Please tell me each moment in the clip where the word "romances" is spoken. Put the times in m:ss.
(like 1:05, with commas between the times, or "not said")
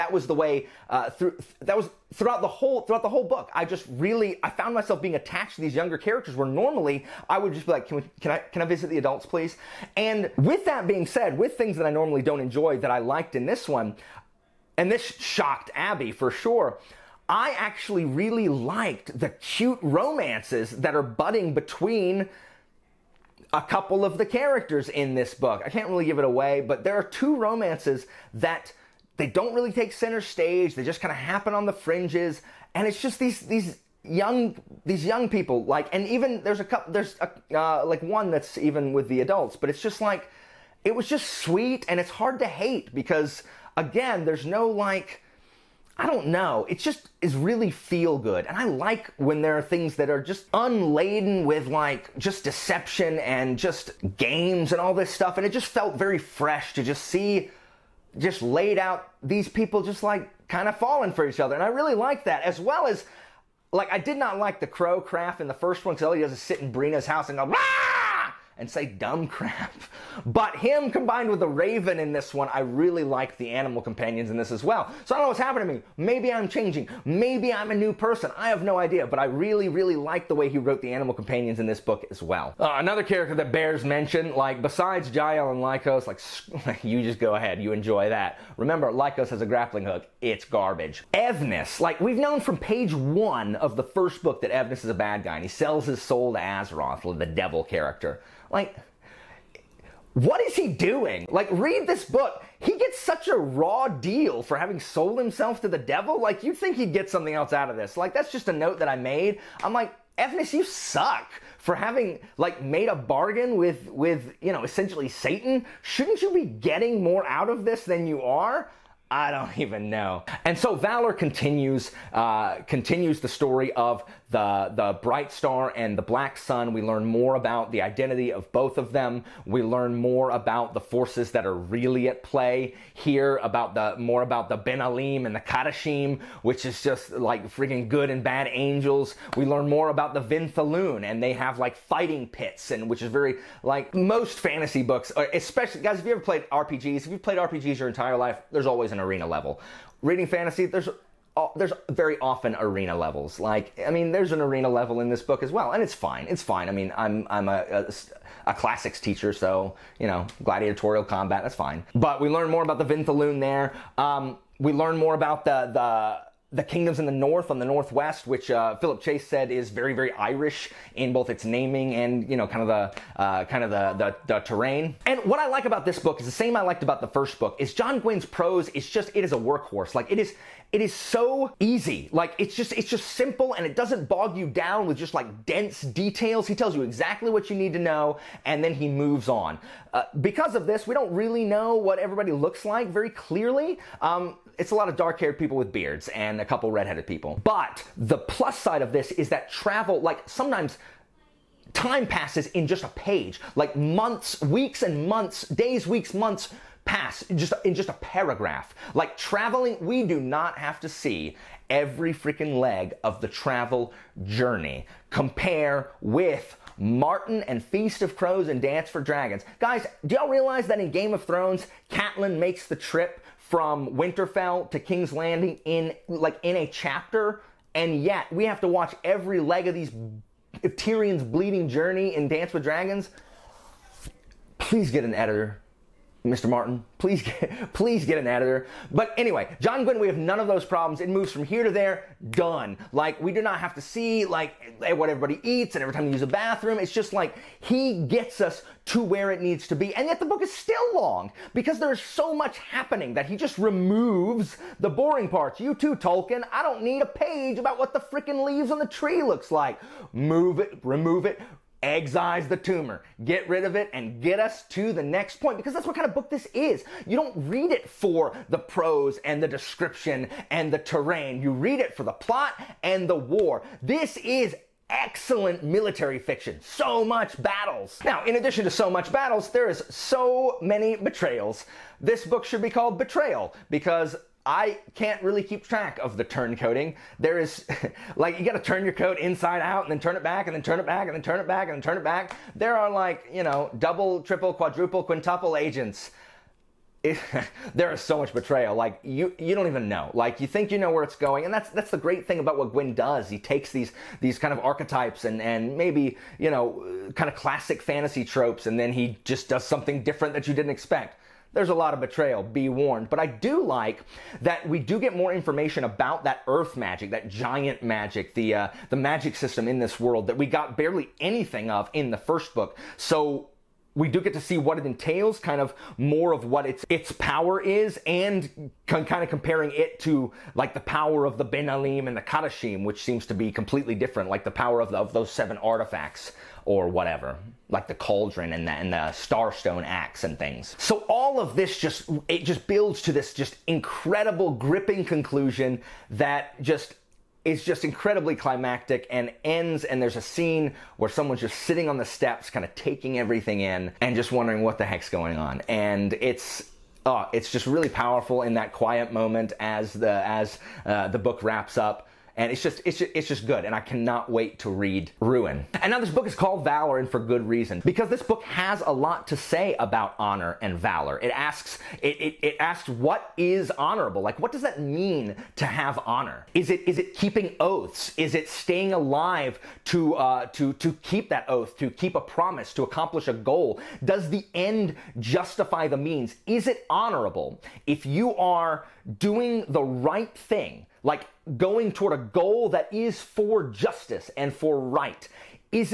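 0:19, 0:27.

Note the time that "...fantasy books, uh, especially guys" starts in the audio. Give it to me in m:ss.
2:24.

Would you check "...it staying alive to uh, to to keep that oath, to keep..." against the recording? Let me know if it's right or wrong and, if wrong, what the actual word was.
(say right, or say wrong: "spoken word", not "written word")
right.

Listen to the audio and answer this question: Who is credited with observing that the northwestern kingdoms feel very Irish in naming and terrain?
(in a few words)
Philip Chase.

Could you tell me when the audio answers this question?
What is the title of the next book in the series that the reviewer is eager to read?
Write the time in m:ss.
6:05.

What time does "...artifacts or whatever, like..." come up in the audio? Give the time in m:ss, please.
5:35.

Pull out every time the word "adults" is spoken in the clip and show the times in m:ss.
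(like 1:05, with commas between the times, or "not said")
0:08, 0:39.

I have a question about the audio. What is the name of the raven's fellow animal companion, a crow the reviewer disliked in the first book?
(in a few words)
Craf.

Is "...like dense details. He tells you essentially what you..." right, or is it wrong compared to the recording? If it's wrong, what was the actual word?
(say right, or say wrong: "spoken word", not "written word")
wrong: "exactly", not "essentially".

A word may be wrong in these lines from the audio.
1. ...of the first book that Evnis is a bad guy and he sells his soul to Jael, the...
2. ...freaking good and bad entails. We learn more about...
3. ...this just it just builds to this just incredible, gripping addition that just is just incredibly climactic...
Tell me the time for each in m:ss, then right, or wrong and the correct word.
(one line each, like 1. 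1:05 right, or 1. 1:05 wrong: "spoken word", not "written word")
1. 1:33 wrong: "Asroth", not "Jael"
2. 2:17 wrong: "angels", not "entails"
3. 5:41 wrong: "conclusion", not "addition".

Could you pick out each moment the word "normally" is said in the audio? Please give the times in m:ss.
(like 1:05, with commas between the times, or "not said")
0:06, 0:11.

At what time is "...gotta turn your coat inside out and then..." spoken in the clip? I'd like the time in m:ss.
4:48.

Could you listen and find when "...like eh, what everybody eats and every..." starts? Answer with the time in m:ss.
4:04.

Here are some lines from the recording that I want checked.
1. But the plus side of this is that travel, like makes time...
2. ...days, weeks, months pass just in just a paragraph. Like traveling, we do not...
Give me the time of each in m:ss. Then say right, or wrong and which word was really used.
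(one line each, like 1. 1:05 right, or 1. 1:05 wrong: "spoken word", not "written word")
1. 3:17 wrong: "sometimes", not "makes"
2. 3:25 right.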